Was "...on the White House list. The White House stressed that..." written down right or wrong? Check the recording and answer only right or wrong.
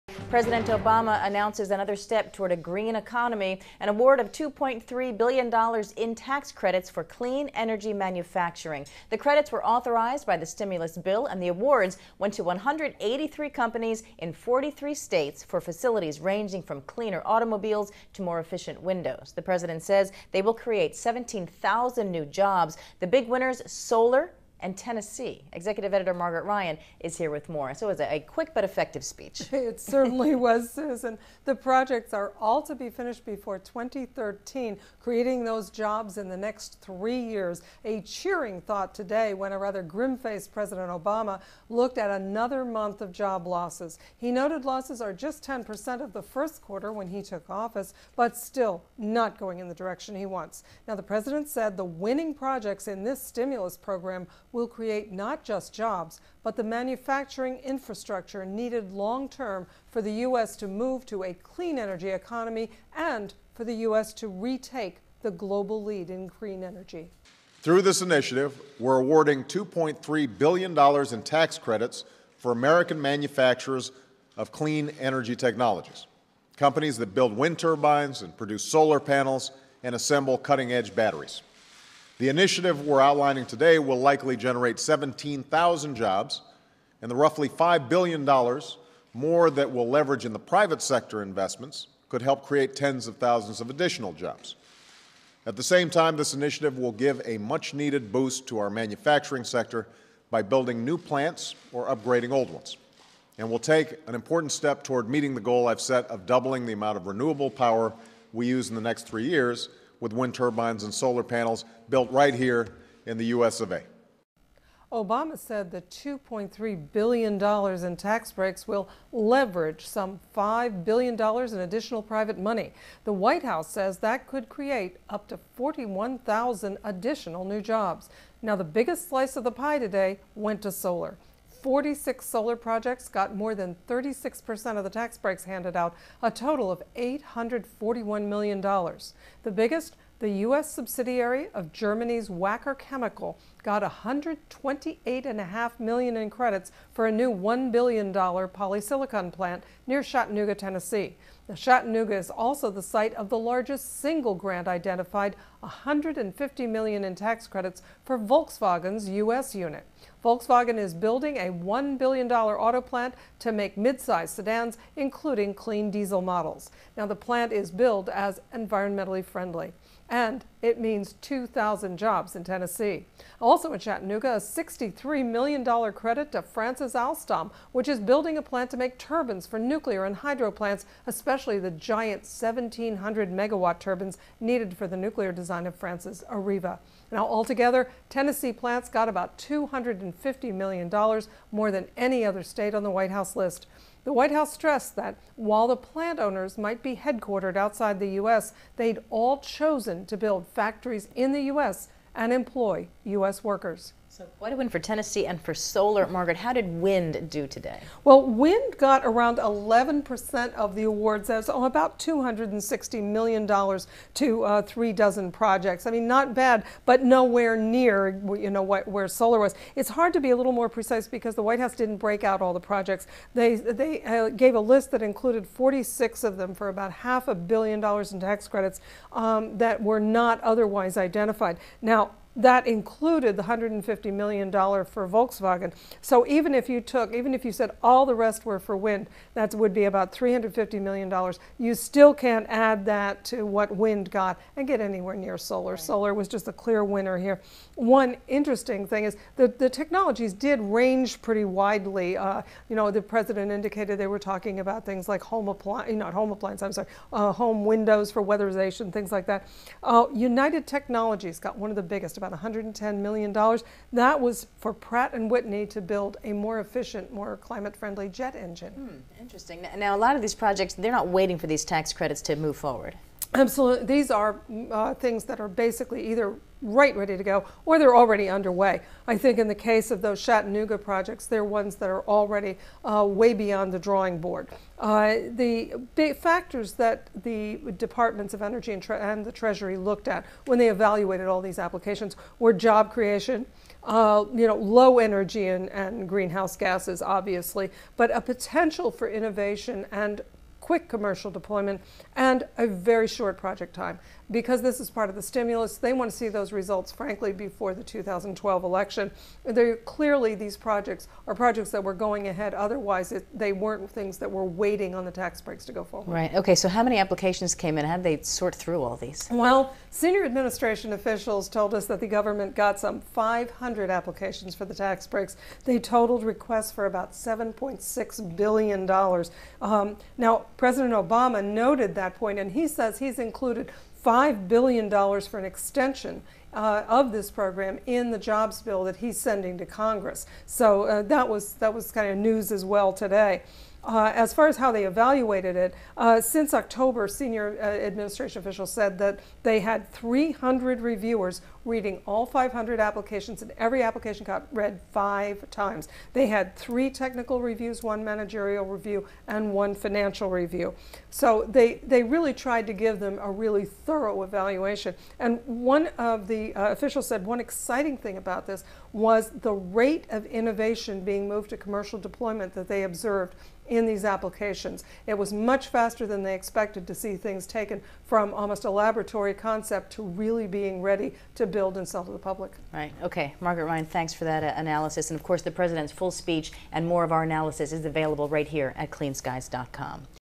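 right.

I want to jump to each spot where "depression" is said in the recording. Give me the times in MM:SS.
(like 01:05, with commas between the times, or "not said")
not said.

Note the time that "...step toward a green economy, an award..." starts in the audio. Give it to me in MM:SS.
00:01.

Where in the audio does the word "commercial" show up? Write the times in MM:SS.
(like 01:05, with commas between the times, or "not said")
05:00, 06:11.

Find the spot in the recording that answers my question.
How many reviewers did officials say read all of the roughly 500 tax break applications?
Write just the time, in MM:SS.
05:49.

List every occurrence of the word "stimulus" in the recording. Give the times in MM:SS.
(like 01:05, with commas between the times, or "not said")
00:10, 00:53, 05:05.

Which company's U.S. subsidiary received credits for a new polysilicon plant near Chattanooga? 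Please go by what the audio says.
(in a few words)
Wacker Chemical.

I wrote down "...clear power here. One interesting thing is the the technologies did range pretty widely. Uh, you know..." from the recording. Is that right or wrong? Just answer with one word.
wrong.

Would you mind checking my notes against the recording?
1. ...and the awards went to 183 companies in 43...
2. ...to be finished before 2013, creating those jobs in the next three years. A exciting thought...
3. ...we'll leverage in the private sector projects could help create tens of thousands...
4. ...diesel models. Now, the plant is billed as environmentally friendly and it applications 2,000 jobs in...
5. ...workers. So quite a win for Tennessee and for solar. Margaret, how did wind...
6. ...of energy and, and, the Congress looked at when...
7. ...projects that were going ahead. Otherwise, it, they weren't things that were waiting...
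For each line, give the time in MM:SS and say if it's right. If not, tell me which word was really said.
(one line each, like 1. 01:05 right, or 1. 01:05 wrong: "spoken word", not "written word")
1. 00:11 right
2. 00:32 wrong: "cheering", not "exciting"
3. 01:29 wrong: "investments", not "projects"
4. 02:45 wrong: "means", not "applications"
5. 03:23 right
6. 04:48 wrong: "Treasury", not "Congress"
7. 05:11 right.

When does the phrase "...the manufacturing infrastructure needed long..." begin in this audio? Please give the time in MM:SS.
00:56.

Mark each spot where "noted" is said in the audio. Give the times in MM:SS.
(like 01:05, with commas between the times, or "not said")
00:44, 05:31.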